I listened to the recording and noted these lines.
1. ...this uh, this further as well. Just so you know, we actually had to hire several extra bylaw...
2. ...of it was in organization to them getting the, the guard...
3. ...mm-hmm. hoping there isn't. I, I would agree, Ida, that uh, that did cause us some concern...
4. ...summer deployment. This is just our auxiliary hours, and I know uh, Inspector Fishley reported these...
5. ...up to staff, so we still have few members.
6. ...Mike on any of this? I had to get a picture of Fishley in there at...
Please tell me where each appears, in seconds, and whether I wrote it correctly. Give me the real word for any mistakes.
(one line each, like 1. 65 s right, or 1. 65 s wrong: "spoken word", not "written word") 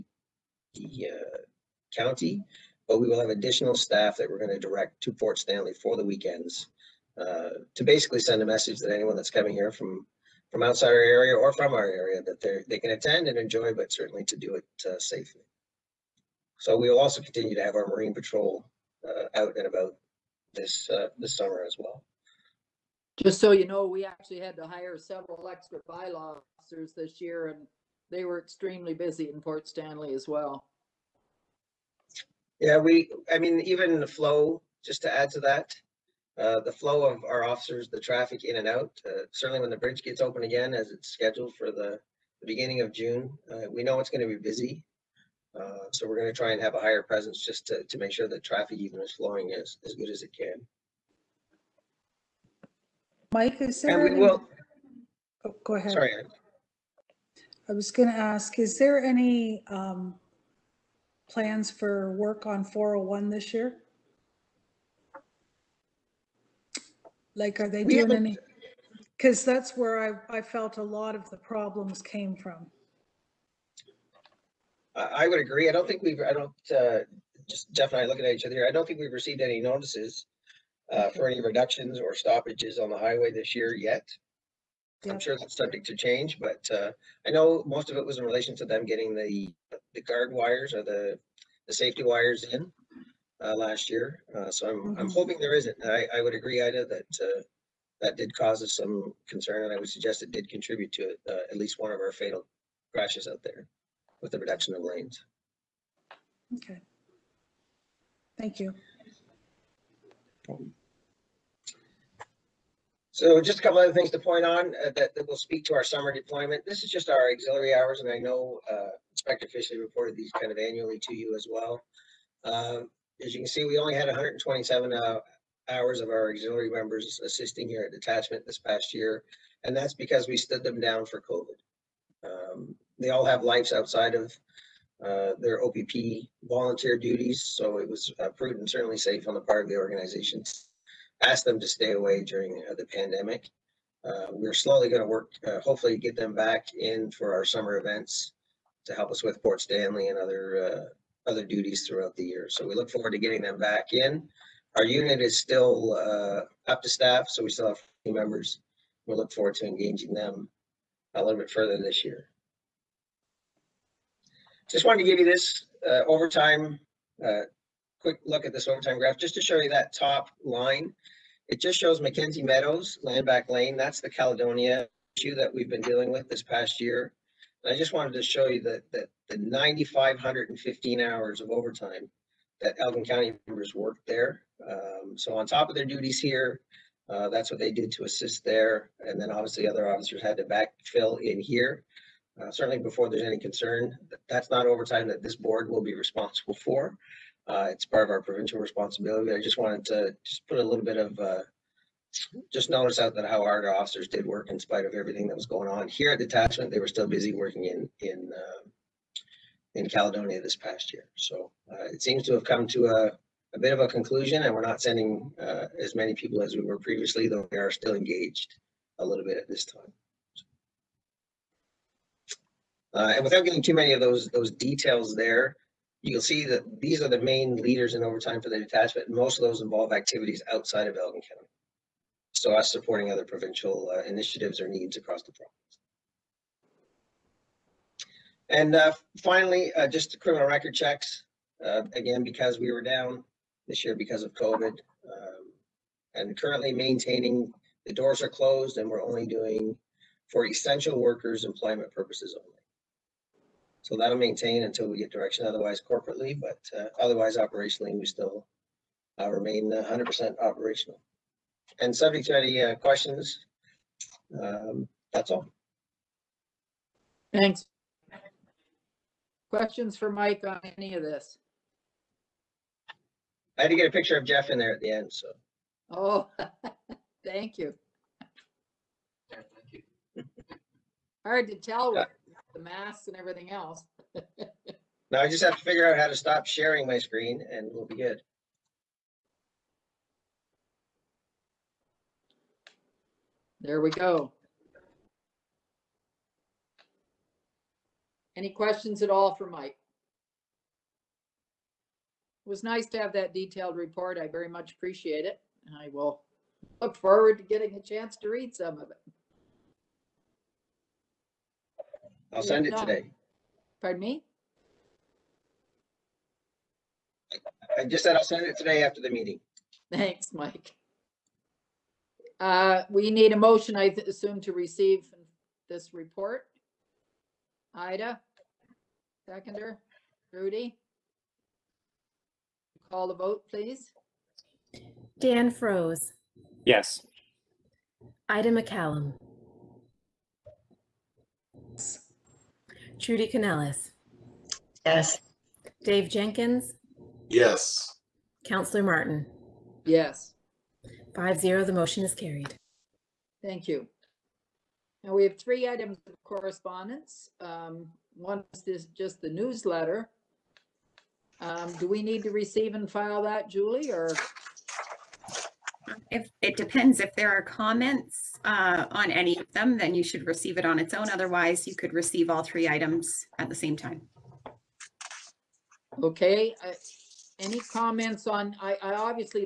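1. 20 s wrong: "summer", not "further"
2. 87 s wrong: "relation", not "organization"
3. 94 s right
4. 115 s right
5. 156 s right
6. 270 s wrong: "Jeff", not "Fishley".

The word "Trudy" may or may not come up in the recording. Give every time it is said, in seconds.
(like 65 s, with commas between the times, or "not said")
342 s.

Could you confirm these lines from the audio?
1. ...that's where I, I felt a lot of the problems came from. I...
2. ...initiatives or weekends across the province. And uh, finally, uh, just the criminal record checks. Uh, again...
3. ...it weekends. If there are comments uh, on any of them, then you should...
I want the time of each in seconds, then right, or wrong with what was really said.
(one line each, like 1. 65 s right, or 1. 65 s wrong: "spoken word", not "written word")
1. 69 s right
2. 234 s wrong: "needs", not "weekends"
3. 366 s wrong: "depends", not "weekends".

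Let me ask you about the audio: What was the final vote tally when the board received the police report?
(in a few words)
5-0.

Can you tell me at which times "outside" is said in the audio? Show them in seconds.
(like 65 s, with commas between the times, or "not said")
10 s, 133 s, 230 s.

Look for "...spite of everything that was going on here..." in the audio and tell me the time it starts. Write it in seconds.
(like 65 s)
204 s.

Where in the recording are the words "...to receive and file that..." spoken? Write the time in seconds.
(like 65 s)
362 s.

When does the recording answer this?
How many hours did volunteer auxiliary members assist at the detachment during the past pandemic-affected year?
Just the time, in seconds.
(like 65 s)
124 s.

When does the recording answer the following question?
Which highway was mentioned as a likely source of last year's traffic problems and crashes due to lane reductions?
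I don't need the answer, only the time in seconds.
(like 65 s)
62 s.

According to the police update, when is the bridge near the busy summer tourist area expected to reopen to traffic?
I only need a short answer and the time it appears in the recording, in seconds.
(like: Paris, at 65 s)
beginning of June, at 42 s.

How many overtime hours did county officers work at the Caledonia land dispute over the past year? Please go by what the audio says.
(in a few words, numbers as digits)
9,515.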